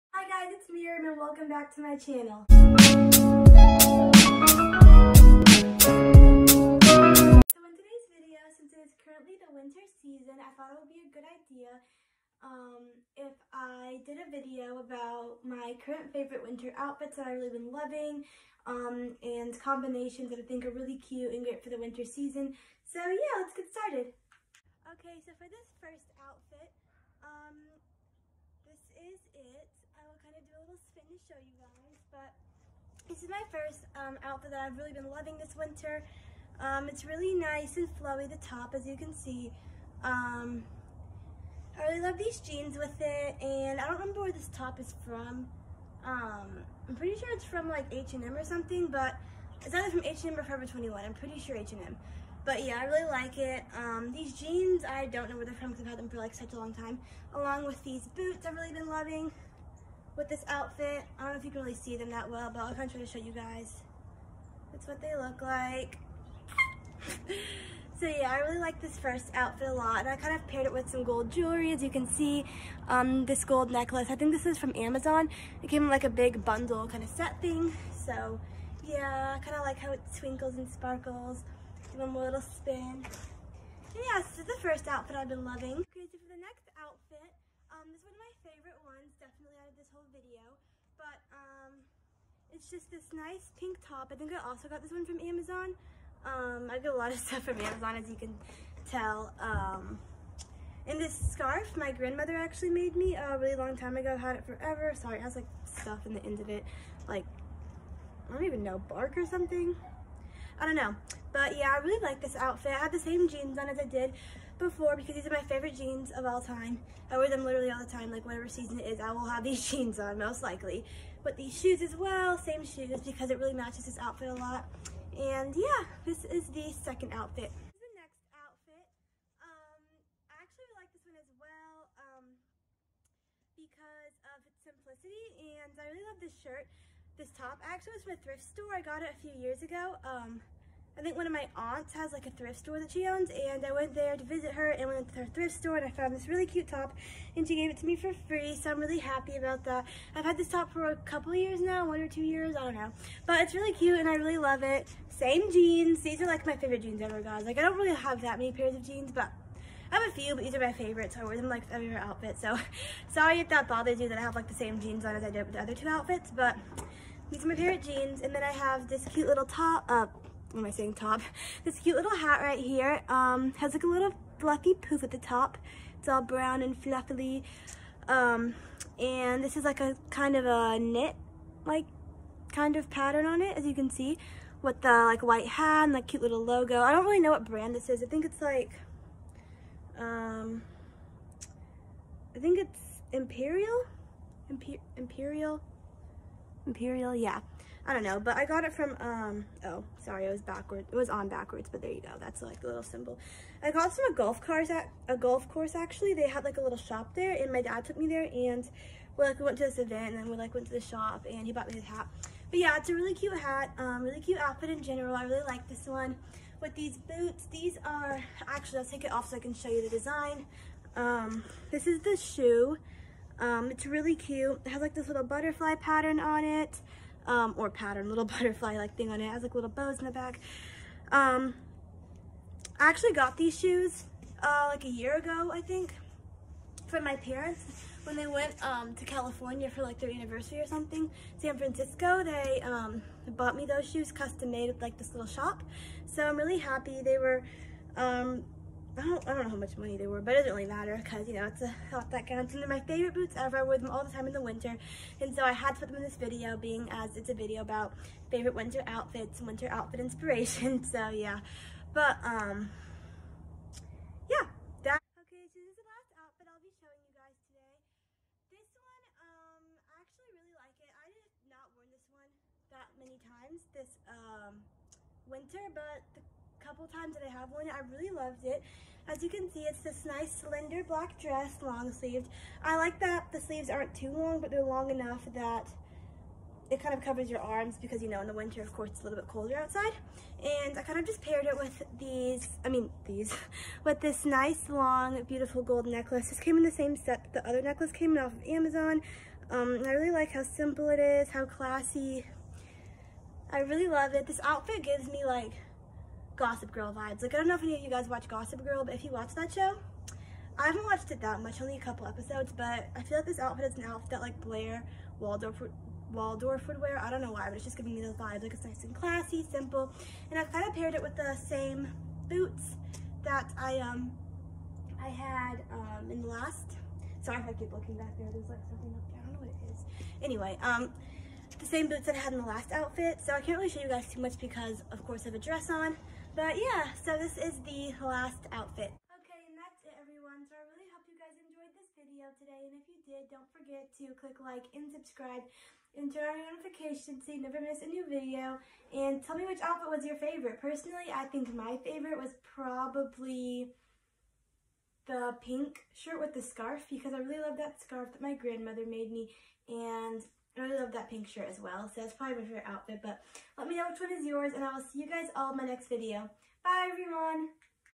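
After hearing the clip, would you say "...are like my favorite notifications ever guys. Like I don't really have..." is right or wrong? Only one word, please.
wrong.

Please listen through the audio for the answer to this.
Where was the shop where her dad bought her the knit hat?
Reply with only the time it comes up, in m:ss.
3:25.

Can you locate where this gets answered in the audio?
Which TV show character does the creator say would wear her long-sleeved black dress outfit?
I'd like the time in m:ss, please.
5:14.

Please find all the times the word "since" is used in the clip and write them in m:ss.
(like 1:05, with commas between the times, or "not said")
0:08.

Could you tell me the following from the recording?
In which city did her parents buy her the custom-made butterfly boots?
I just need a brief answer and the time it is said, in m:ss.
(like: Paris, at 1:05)
San Francisco, at 4:01.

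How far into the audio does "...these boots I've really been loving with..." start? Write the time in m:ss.
0:57.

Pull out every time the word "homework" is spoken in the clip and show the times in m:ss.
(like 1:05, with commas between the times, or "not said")
not said.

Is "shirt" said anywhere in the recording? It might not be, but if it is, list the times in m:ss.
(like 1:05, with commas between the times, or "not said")
2:16, 5:55, 6:01.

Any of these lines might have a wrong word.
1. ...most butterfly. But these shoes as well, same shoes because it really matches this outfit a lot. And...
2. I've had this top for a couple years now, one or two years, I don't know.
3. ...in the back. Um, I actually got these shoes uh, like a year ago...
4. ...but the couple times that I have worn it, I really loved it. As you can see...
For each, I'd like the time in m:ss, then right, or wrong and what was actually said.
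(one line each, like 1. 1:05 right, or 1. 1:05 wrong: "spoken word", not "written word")
1. 2:00 wrong: "likely", not "butterfly"
2. 2:30 right
3. 3:49 right
4. 4:35 right.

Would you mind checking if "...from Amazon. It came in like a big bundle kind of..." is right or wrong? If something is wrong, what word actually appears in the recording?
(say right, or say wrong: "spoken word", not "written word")
right.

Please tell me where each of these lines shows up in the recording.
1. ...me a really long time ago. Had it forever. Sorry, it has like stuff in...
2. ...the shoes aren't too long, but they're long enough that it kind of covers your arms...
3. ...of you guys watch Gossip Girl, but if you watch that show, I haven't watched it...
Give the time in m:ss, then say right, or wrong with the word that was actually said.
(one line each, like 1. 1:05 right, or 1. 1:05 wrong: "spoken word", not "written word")
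1. 1:42 right
2. 4:43 wrong: "sleeves", not "shoes"
3. 5:07 right.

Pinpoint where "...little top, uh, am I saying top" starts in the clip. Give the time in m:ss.
2:49.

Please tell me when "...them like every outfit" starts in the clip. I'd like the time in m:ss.
2:41.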